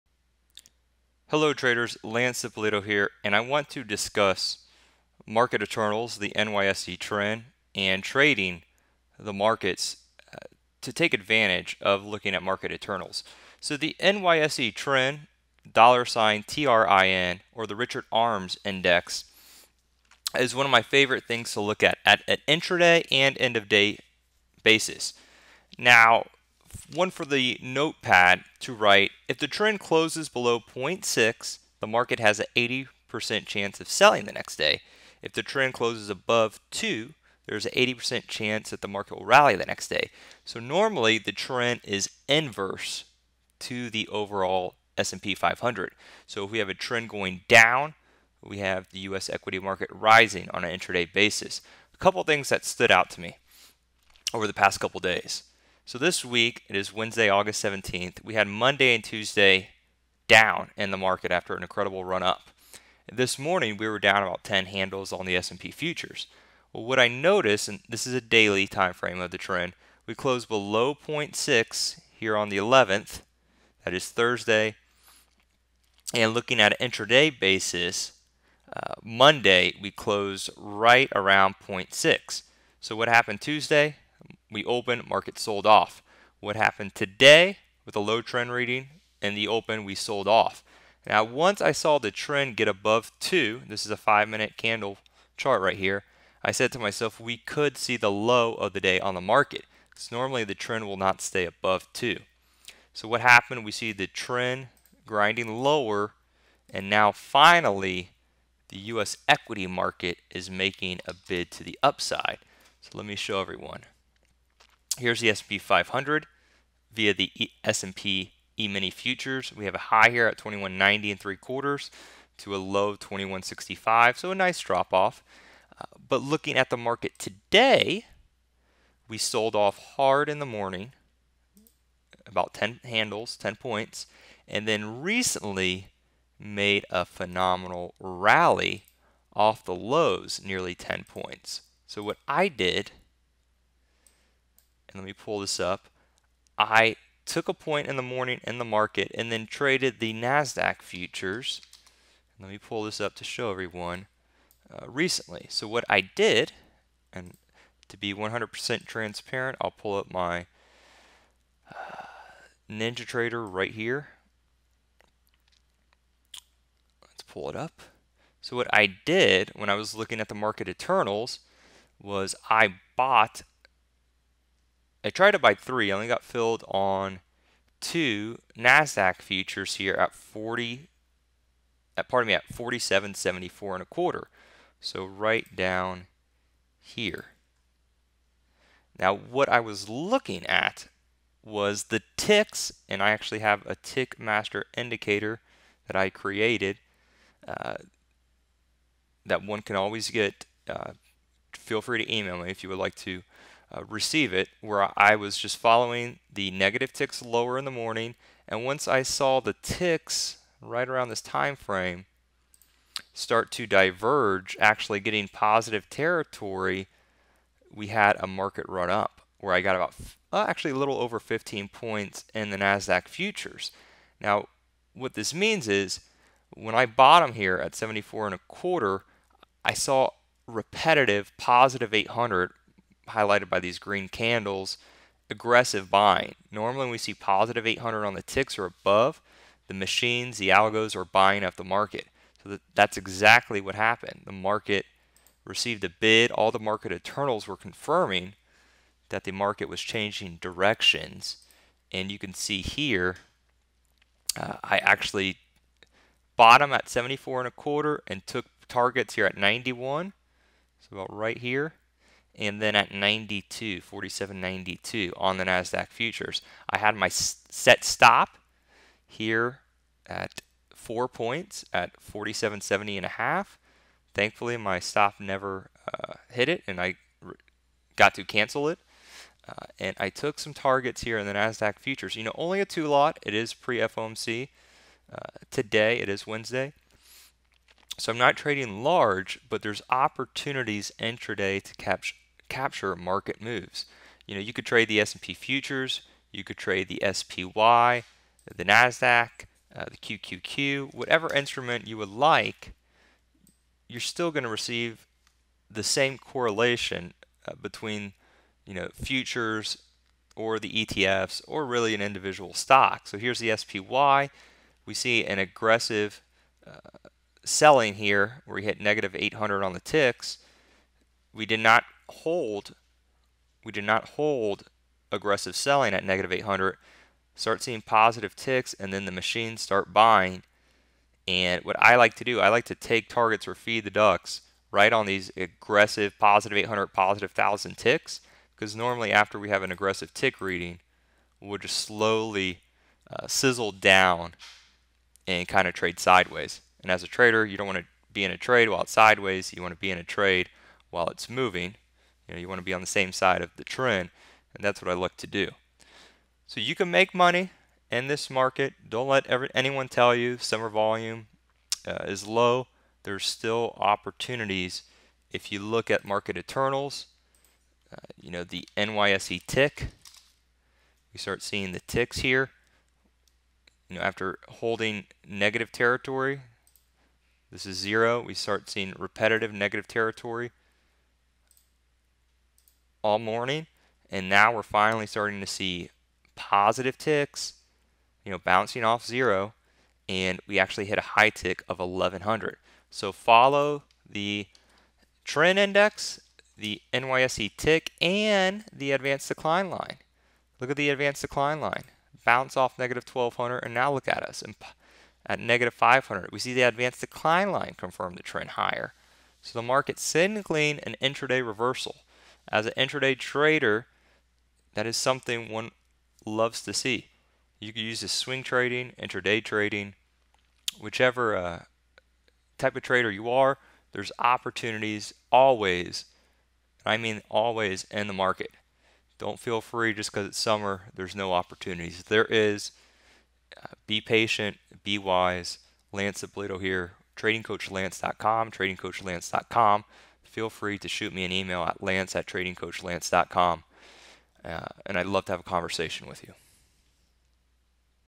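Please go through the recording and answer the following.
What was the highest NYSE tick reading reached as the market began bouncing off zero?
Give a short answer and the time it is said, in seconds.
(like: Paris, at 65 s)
1100, at 391 s.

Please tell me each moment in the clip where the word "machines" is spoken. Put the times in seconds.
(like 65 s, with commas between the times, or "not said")
239 s, 329 s.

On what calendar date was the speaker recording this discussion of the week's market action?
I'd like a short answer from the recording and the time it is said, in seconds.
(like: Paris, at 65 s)
August 17th, at 57 s.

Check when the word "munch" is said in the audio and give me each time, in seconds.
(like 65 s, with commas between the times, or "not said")
not said.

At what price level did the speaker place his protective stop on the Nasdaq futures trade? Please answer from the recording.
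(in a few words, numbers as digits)
47.70 and a half.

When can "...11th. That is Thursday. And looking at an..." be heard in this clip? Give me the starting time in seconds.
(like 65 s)
72 s.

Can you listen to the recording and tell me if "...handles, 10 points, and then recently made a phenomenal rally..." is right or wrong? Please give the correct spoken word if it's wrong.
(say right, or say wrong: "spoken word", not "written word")
right.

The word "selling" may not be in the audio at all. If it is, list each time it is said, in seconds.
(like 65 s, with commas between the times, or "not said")
33 s, 317 s, 325 s.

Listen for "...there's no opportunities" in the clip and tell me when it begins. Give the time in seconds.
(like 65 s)
430 s.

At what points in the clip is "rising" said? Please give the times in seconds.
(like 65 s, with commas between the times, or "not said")
49 s.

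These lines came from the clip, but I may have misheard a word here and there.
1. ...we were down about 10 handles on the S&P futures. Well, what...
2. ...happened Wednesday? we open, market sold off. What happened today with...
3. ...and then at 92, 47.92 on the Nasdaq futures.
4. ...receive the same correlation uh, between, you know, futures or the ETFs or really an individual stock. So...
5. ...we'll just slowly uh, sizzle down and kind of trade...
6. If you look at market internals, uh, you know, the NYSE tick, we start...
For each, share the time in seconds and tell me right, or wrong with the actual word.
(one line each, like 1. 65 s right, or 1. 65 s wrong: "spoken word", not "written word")
1. 63 s right
2. 83 s wrong: "Tuesday", not "Wednesday"
3. 262 s right
4. 304 s right
5. 341 s right
6. 365 s right.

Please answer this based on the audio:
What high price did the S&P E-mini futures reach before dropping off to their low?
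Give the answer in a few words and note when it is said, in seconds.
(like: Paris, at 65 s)
2190 and three quarters, at 120 s.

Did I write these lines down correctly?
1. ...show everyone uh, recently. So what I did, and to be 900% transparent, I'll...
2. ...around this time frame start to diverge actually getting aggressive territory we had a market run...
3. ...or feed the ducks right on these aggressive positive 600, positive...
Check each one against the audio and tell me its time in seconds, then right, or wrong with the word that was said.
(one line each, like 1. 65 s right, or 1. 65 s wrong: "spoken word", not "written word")
1. 153 s wrong: "100", not "900"
2. 210 s wrong: "positive", not "aggressive"
3. 333 s wrong: "800", not "600".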